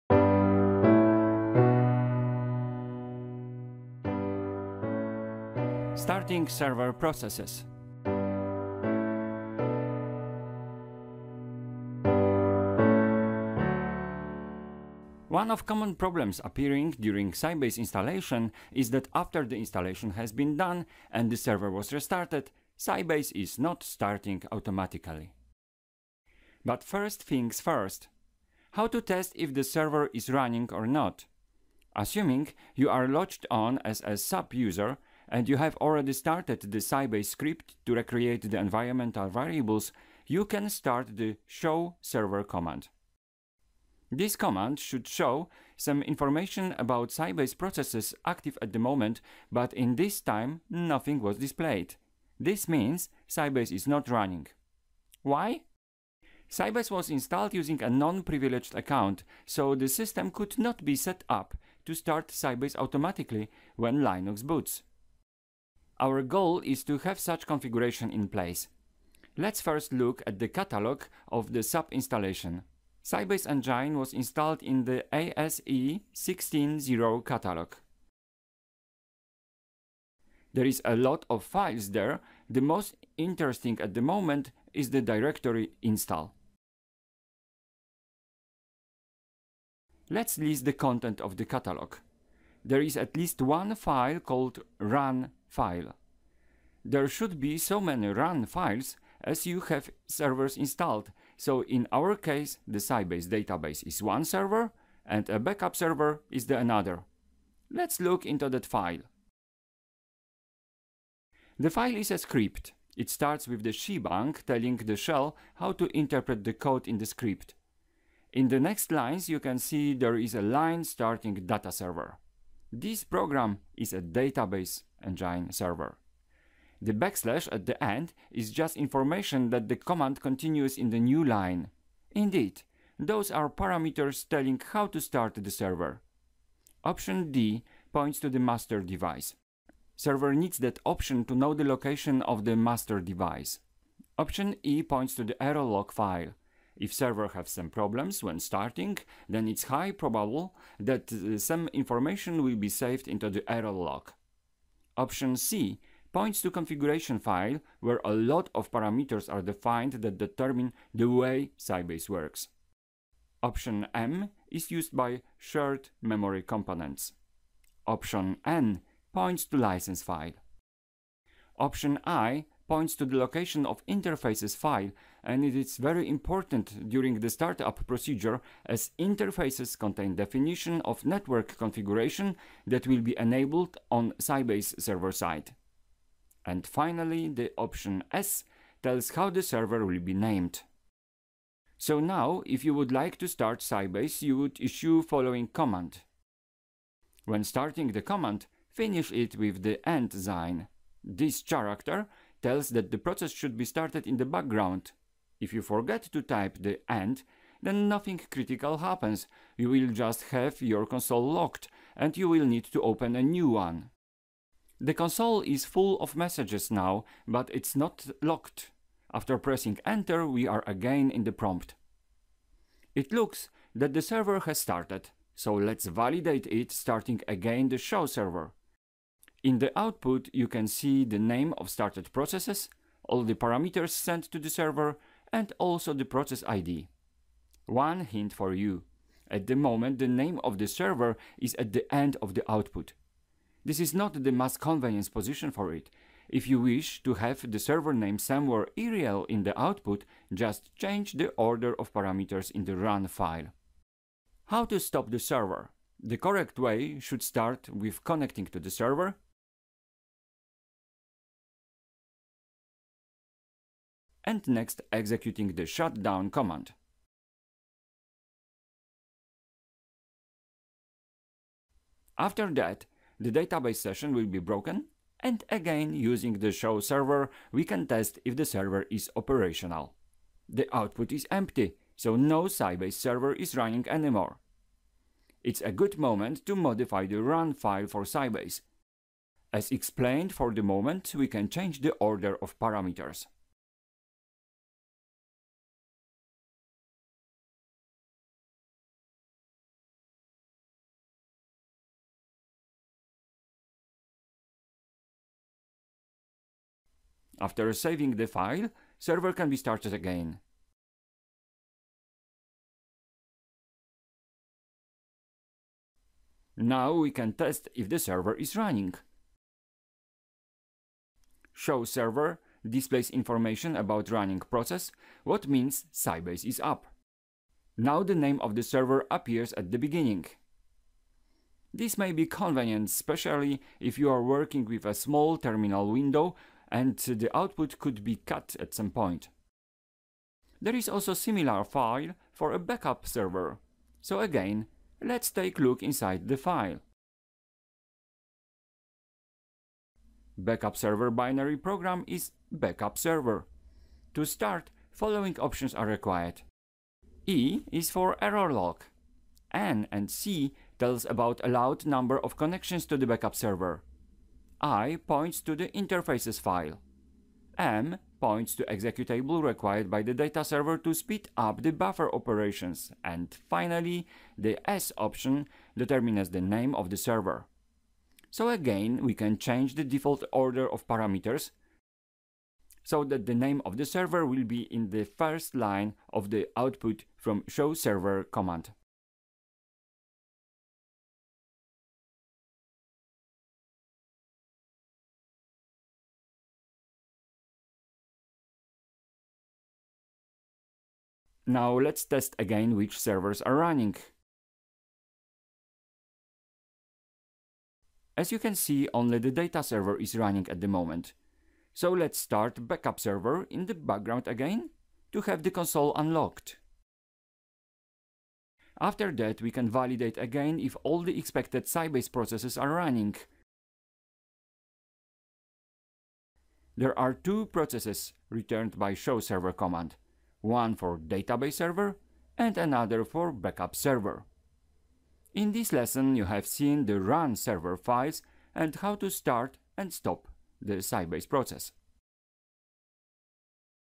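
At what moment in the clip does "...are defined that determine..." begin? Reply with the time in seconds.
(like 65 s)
159 s.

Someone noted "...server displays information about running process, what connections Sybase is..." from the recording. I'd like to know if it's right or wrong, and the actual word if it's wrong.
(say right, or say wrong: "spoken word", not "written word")
wrong: "means", not "connections".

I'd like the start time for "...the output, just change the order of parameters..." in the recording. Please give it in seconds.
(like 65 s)
249 s.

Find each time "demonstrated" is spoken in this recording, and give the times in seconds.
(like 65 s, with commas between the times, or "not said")
not said.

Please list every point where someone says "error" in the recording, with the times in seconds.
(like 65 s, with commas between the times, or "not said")
145 s, 153 s, 358 s.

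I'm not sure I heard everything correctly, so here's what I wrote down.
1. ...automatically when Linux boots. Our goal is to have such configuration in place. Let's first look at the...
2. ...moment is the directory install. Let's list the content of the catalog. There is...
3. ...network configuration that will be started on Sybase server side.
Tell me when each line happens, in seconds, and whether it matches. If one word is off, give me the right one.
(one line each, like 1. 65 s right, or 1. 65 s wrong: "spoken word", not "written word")
1. 62 s right
2. 84 s right
3. 181 s wrong: "enabled", not "started".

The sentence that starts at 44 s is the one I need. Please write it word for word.
This command should show some information about Sybase processes active at the moment, but in this time nothing was displayed.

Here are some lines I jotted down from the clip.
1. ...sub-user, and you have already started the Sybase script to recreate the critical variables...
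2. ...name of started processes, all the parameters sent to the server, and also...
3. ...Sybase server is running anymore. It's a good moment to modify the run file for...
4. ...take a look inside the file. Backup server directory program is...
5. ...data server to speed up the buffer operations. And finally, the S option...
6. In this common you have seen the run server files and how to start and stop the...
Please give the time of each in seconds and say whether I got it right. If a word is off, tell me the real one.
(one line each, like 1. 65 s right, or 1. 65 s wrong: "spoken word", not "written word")
1. 34 s wrong: "environmental", not "critical"
2. 231 s right
3. 282 s right
4. 345 s wrong: "binary", not "directory"
5. 370 s right
6. 435 s wrong: "lesson", not "common".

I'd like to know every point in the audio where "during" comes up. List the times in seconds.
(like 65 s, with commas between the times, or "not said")
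16 s, 176 s.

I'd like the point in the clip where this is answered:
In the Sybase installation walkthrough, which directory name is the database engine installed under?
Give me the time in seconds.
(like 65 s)
75 s.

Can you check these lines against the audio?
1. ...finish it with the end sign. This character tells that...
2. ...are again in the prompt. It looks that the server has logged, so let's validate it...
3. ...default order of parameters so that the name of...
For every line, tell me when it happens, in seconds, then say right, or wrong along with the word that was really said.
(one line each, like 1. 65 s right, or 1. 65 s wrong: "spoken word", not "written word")
1. 198 s right
2. 220 s wrong: "started", not "logged"
3. 379 s right.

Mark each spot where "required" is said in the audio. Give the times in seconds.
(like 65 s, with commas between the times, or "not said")
355 s, 369 s.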